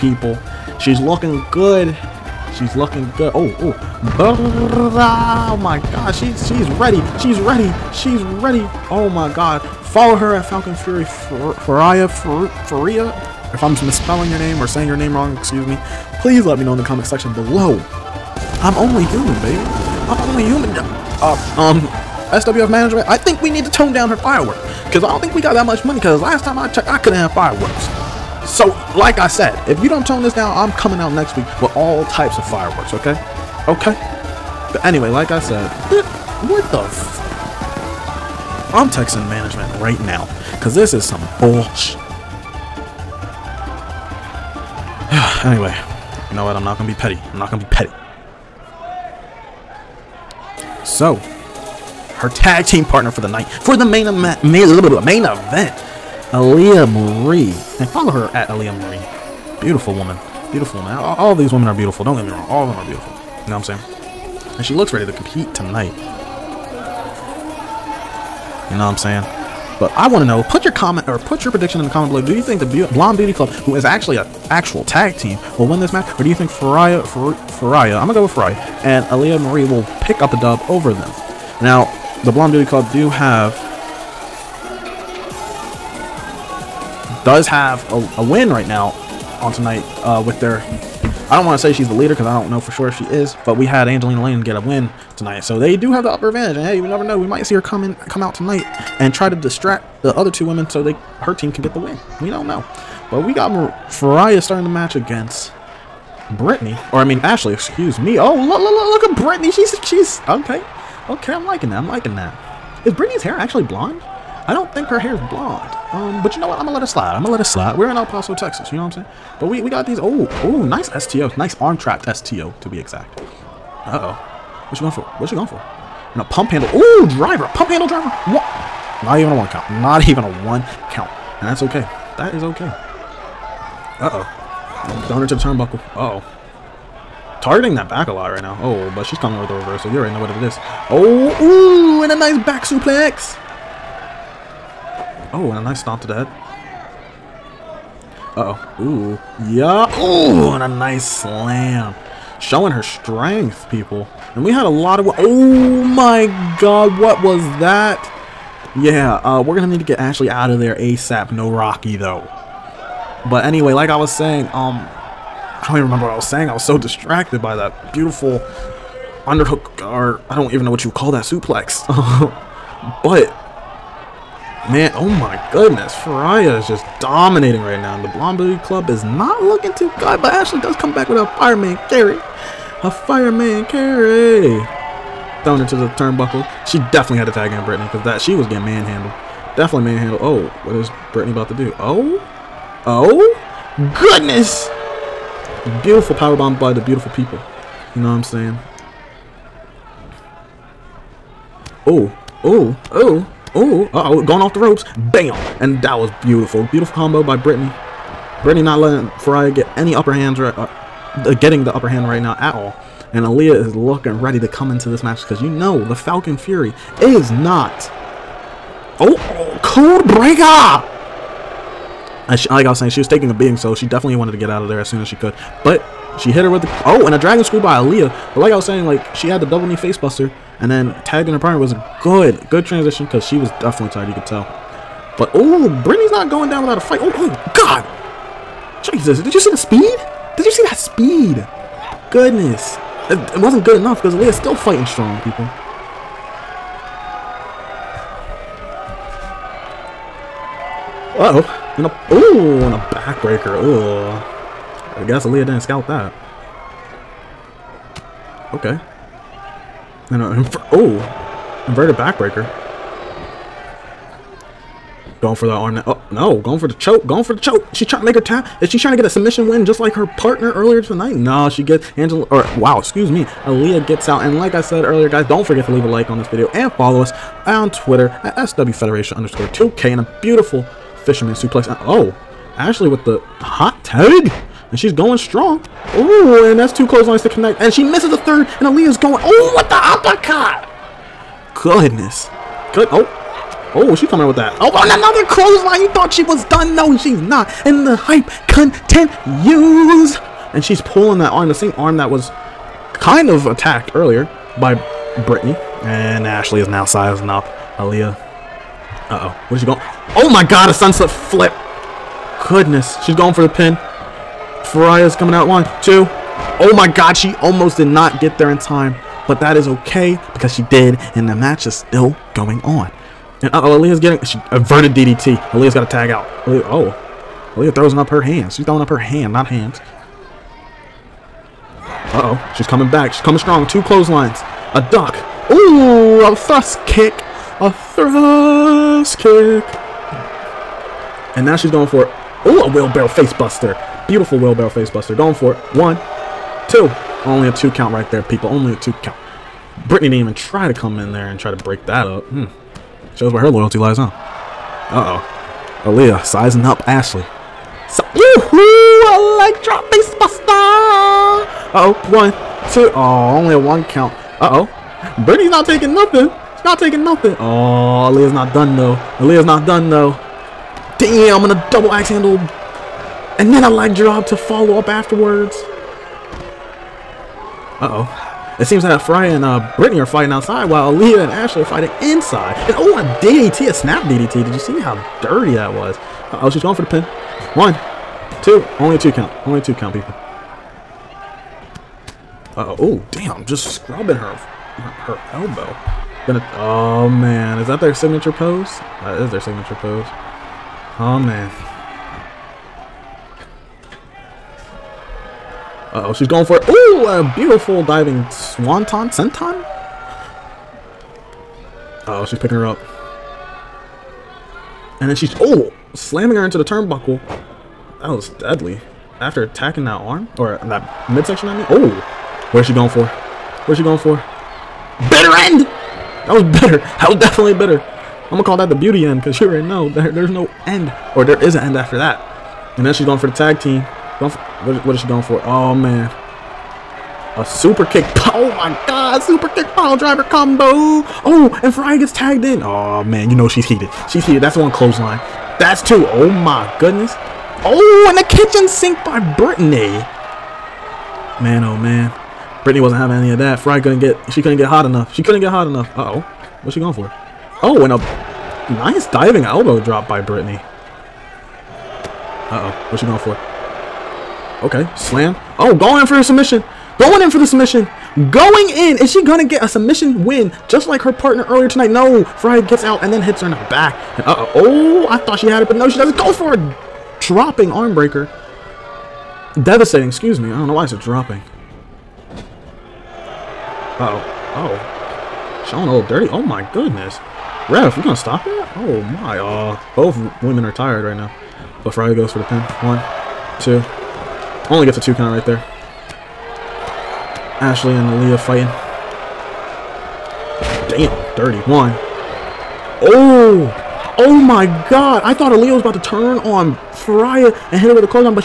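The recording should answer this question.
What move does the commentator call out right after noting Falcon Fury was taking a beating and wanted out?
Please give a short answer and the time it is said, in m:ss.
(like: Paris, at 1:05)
Code Breaker, at 3:39.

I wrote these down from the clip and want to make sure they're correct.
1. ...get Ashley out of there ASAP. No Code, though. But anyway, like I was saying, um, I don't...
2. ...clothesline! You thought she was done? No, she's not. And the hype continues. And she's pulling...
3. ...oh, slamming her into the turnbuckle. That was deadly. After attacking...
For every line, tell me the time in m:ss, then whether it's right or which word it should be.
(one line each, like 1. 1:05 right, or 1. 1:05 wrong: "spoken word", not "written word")
1. 2:39 wrong: "Rocky", not "Code"
2. 4:55 right
3. 6:55 right.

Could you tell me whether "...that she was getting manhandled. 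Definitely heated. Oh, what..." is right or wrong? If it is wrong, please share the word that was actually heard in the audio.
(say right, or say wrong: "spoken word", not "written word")
wrong: "manhandled", not "heated".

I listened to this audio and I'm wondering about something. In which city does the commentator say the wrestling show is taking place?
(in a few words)
El Paso, Texas.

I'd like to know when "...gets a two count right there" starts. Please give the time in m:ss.
8:14.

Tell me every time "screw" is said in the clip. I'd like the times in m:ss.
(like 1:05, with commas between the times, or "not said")
3:47.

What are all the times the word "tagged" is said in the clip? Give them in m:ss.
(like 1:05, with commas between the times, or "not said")
3:51, 7:22.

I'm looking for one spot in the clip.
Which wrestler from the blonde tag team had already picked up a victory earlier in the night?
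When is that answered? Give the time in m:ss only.
1:33.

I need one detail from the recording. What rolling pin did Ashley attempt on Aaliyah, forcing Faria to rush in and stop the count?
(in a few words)
Sunset flip.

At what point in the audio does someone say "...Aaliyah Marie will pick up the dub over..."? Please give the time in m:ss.
1:19.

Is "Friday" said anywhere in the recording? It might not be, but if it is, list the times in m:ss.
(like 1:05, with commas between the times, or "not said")
8:11.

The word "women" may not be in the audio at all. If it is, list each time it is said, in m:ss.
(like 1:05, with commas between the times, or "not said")
1:01, 1:40, 8:10.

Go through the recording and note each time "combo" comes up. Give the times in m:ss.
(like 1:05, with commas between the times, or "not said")
3:26, 7:20.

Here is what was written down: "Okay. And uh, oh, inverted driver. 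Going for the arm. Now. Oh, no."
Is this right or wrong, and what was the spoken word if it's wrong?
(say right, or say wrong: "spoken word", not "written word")
wrong: "backbreaker", not "driver".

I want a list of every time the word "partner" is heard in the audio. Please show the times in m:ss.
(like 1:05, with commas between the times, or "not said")
0:52, 3:51, 4:30, 7:51.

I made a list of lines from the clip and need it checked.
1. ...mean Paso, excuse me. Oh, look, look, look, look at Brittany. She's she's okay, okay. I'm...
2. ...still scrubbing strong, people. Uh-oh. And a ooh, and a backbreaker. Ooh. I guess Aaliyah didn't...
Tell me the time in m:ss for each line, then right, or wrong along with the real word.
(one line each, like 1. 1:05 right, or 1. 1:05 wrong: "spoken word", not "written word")
1. 1:47 wrong: "Ashley", not "Paso"
2. 4:04 wrong: "fighting", not "scrubbing".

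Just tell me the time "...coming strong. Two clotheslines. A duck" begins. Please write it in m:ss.
5:33.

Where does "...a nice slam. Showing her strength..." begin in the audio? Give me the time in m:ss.
2:30.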